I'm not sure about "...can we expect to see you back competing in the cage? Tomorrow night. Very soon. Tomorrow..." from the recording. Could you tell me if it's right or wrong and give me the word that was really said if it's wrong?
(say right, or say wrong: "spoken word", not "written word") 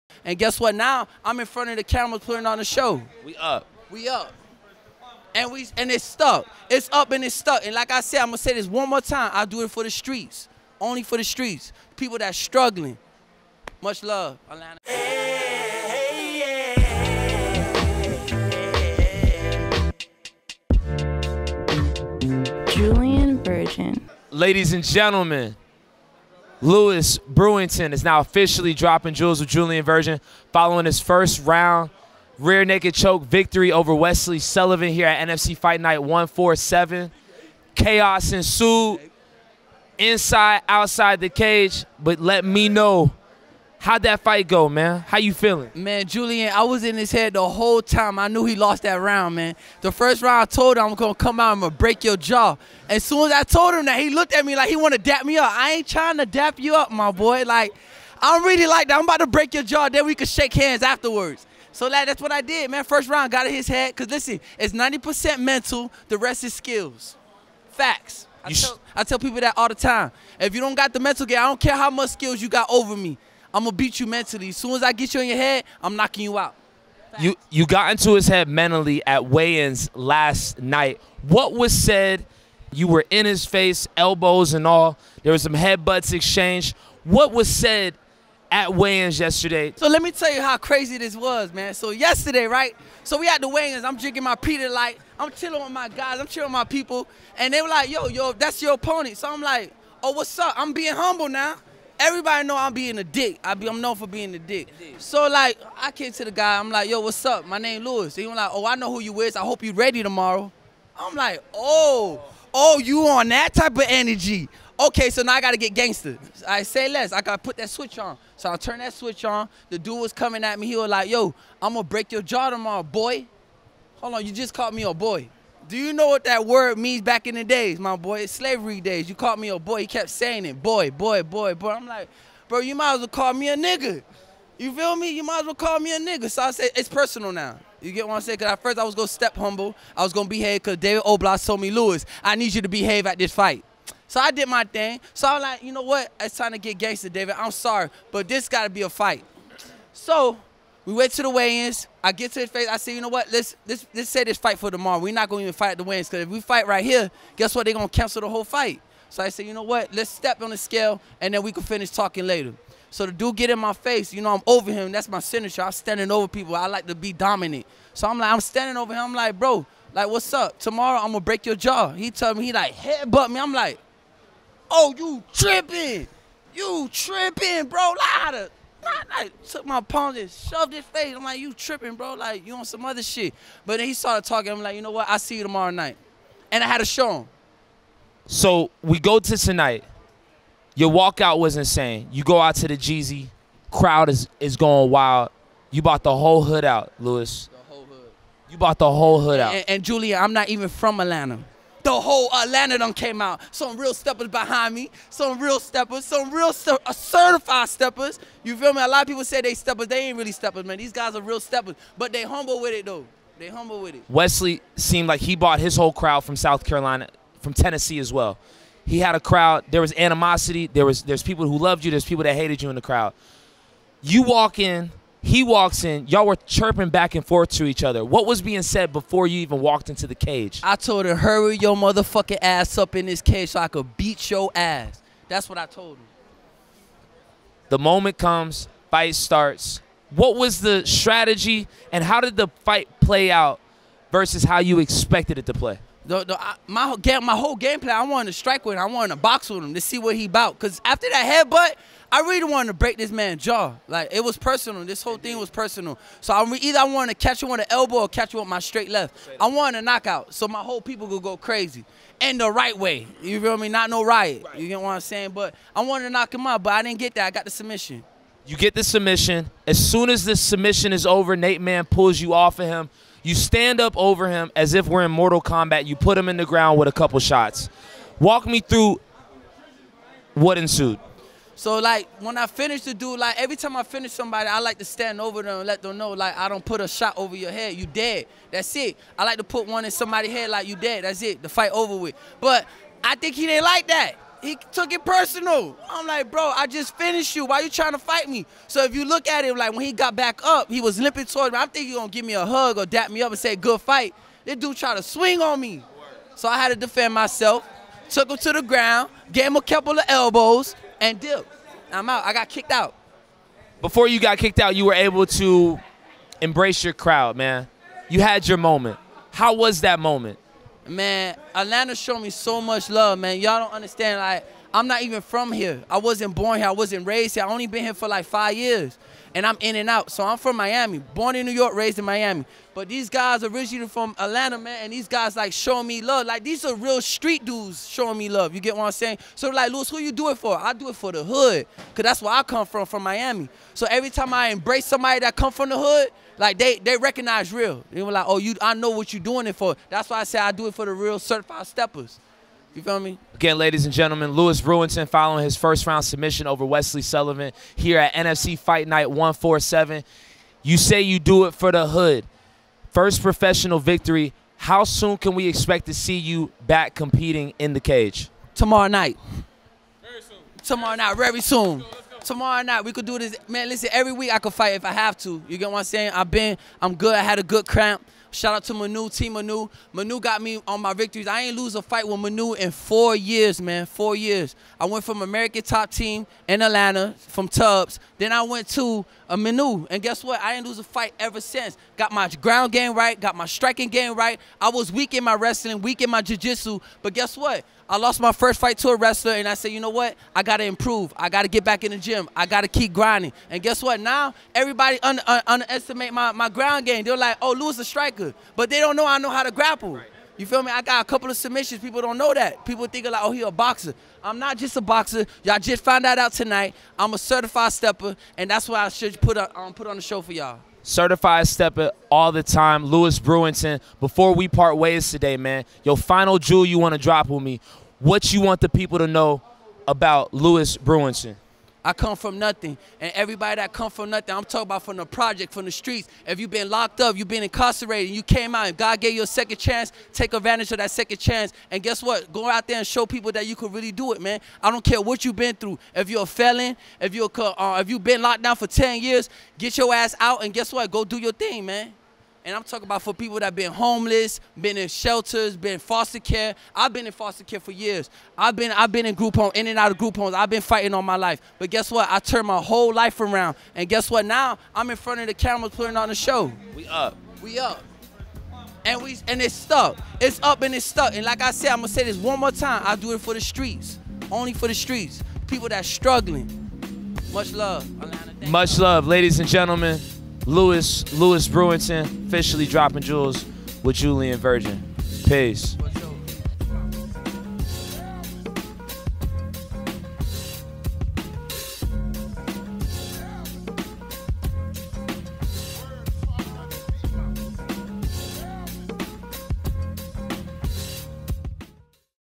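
right.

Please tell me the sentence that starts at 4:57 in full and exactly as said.
Why you trying to fight me?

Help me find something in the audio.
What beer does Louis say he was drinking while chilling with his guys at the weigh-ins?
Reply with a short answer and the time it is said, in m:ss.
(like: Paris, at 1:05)
Peter Light, at 1:34.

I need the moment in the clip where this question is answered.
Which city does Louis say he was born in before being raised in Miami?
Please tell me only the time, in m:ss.
5:31.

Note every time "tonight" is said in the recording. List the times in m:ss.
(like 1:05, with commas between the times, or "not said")
3:09, 6:56.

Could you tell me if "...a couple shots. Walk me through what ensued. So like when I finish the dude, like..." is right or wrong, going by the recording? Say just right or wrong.
right.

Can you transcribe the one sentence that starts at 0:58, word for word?
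I'm about to break your jaw, then we could shake hands afterwards.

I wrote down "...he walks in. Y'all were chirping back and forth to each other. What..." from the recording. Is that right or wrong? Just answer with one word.
right.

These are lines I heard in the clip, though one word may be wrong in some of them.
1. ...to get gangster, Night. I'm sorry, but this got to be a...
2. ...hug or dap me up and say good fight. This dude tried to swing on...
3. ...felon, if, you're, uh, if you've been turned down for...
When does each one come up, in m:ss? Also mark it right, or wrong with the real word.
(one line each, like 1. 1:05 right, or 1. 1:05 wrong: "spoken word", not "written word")
1. 2:26 wrong: "David", not "Night"
2. 5:02 right
3. 7:26 wrong: "locked", not "turned".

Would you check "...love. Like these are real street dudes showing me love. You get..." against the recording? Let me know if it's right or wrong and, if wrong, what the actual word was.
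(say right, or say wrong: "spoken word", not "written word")
right.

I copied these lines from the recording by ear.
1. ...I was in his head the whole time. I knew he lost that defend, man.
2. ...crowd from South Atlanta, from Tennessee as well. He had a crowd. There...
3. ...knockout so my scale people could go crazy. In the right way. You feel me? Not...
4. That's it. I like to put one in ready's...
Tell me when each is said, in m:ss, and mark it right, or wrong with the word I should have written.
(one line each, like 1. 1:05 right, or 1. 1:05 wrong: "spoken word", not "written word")
1. 0:46 wrong: "round", not "defend"
2. 3:35 wrong: "Carolina", not "Atlanta"
3. 4:19 wrong: "whole", not "scale"
4. 4:48 wrong: "somebody", not "ready".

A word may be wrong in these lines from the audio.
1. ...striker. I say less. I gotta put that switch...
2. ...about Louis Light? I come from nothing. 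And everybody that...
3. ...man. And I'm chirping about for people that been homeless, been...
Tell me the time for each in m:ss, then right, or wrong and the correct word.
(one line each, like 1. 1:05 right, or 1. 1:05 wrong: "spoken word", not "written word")
1. 1:55 wrong: "gangster", not "striker"
2. 7:09 wrong: "Brewington", not "Light"
3. 7:31 wrong: "talking", not "chirping".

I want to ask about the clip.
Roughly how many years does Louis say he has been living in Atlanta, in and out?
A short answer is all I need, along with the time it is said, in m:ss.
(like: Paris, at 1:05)
5, at 5:28.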